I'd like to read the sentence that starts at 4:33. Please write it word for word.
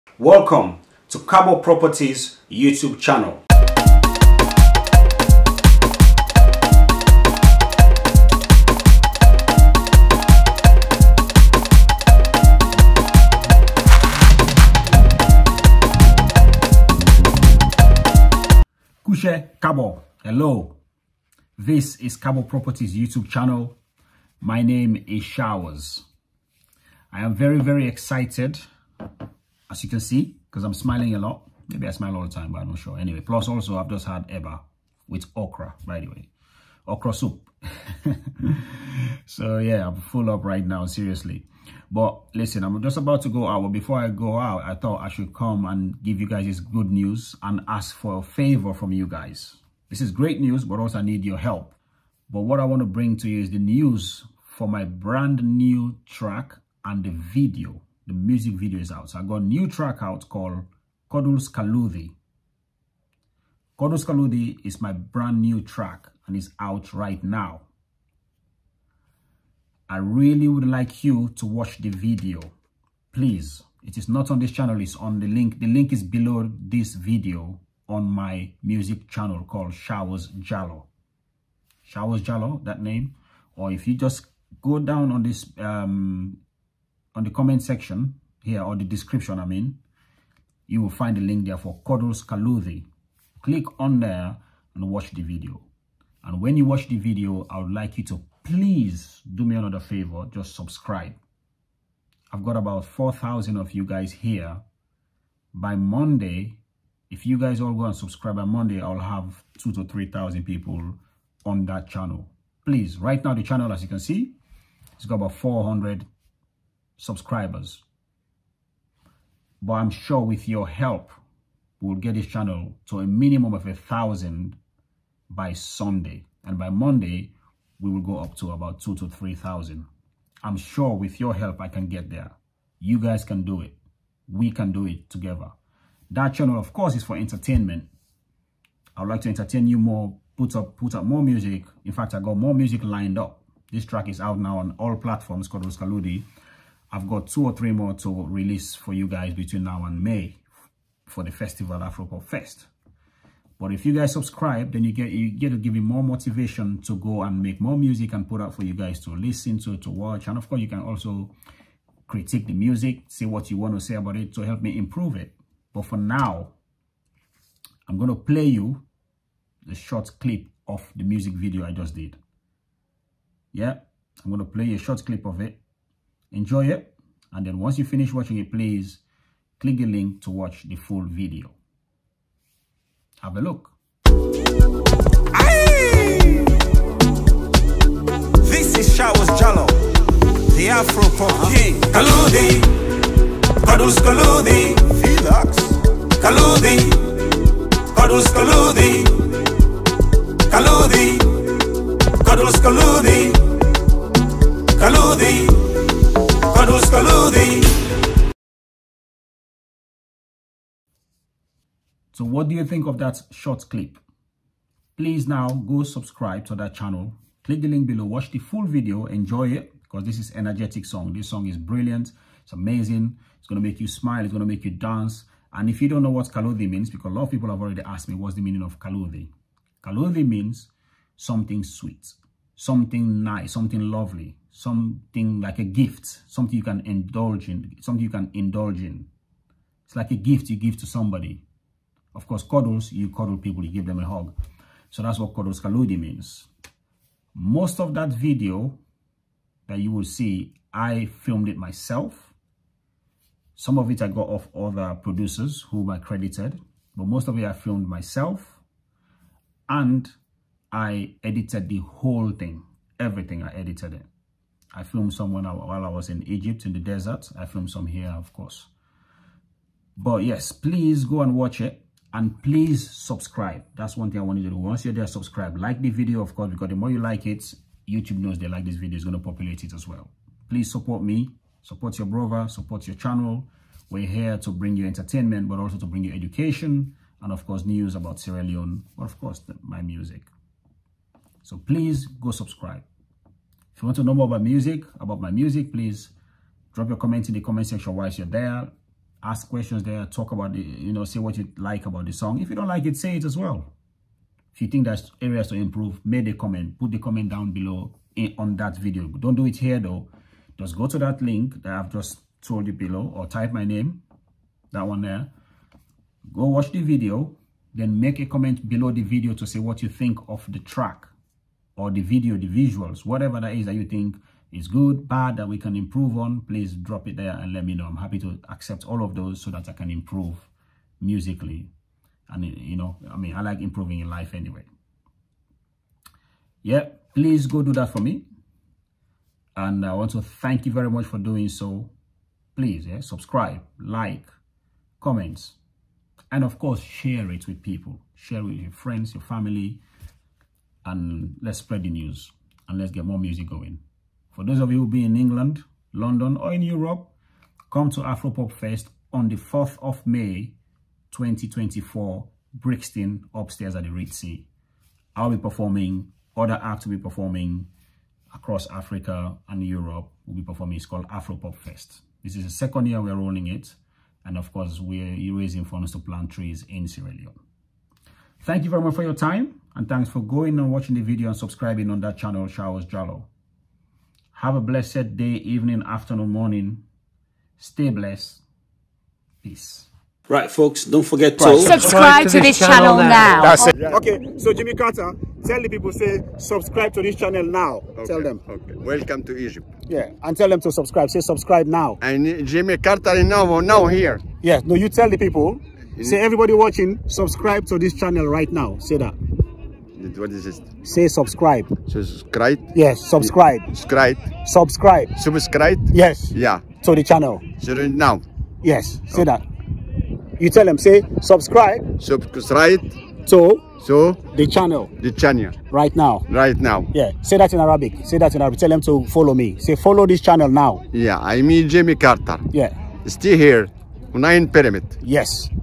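That's one thing I want you to do.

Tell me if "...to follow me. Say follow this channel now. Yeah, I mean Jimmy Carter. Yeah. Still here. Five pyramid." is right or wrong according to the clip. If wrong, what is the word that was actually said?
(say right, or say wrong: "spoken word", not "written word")
wrong: "Nine", not "Five".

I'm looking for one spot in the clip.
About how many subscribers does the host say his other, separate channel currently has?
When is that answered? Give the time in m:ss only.
1:55.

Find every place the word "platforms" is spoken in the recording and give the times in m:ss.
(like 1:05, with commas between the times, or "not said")
2:24.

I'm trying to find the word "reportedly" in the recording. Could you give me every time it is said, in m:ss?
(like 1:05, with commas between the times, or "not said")
not said.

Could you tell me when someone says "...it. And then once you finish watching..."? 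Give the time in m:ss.
2:56.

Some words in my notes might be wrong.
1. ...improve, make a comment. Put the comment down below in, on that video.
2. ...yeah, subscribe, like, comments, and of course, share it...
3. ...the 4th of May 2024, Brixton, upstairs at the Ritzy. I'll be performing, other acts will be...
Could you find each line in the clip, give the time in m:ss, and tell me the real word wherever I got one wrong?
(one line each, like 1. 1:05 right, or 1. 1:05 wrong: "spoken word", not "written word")
1. 5:05 right
2. 5:42 right
3. 5:59 right.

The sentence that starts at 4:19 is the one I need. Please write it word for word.
And I edited the whole thing, everything I edited it.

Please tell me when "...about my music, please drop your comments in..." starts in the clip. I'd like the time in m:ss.
4:54.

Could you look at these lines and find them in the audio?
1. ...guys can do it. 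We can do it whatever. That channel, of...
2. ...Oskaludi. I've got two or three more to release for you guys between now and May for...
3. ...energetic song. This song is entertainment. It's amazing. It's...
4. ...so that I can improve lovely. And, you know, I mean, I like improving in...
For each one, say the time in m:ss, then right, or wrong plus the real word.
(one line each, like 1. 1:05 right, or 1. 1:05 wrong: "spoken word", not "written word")
1. 2:12 wrong: "together", not "whatever"
2. 2:25 right
3. 3:40 wrong: "brilliant", not "entertainment"
4. 5:29 wrong: "musically", not "lovely".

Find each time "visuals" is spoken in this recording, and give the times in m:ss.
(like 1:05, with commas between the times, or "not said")
5:22.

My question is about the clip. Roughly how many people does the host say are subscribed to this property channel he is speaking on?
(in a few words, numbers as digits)
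4000.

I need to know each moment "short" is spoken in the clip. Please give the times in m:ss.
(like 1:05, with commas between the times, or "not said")
2:49, 2:54, 3:33.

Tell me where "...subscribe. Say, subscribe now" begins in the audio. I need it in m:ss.
6:40.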